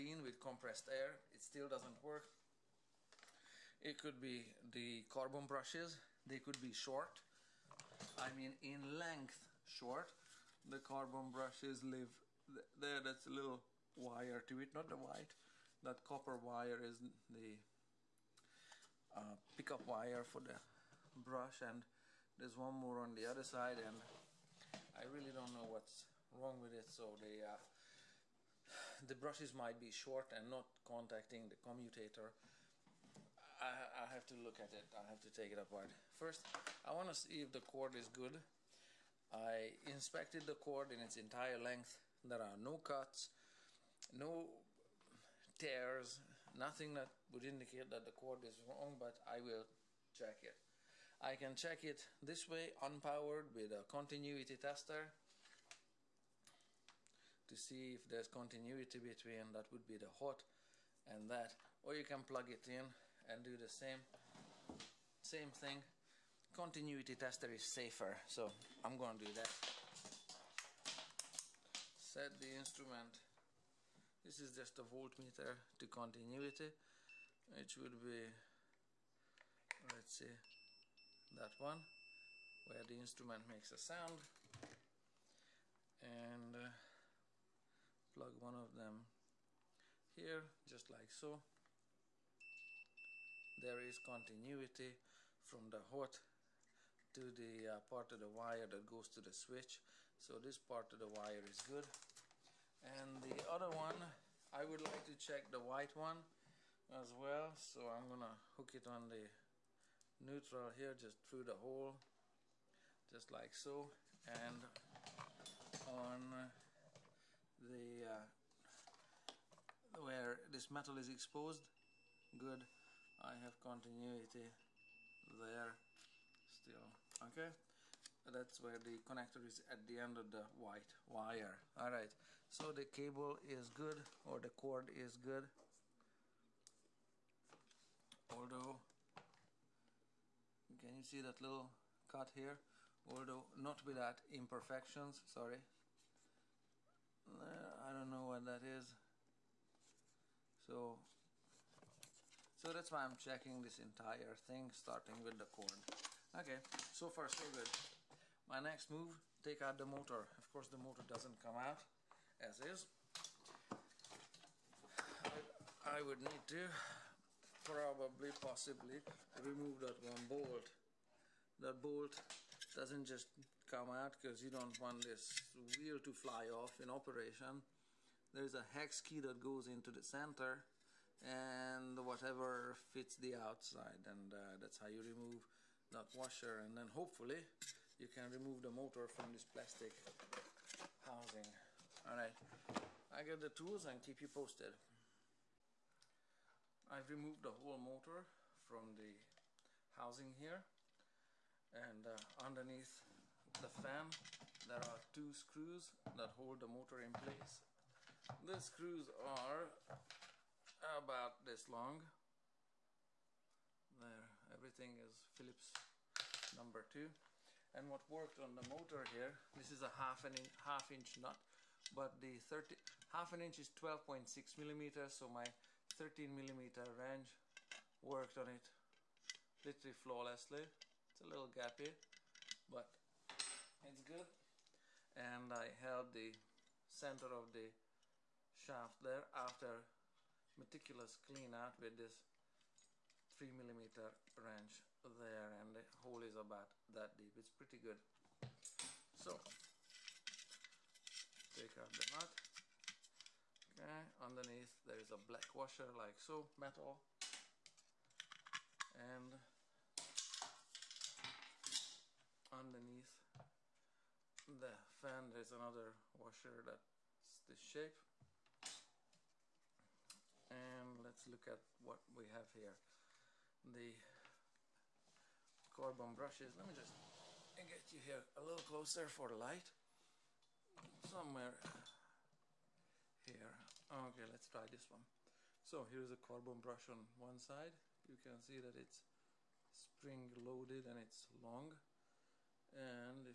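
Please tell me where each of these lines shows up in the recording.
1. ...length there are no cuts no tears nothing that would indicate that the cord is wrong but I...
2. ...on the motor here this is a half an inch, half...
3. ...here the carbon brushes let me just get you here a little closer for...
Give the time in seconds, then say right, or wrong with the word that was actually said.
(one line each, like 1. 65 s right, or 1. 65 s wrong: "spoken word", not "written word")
1. 41 s right
2. 218 s right
3. 272 s right.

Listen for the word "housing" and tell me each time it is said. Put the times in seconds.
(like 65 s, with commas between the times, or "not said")
191 s, 199 s.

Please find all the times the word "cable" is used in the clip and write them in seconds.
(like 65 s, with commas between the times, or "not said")
132 s.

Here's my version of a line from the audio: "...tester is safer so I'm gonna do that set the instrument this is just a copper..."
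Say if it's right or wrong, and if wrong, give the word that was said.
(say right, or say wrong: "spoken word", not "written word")
wrong: "voltmeter", not "copper".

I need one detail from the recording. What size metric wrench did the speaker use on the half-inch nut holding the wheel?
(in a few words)
13 millimeter.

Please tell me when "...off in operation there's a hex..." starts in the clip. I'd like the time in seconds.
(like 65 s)
176 s.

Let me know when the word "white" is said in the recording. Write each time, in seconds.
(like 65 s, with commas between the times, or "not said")
14 s, 105 s, 130 s.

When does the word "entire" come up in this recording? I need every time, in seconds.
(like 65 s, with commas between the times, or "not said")
41 s, 153 s.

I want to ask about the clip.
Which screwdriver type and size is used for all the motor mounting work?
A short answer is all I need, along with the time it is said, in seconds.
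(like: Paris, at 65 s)
Phillips number 2, at 215 s.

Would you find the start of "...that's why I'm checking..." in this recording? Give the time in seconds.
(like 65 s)
152 s.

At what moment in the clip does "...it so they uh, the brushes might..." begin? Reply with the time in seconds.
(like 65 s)
26 s.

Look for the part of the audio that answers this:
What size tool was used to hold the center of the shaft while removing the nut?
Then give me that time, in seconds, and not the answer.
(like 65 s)
243 s.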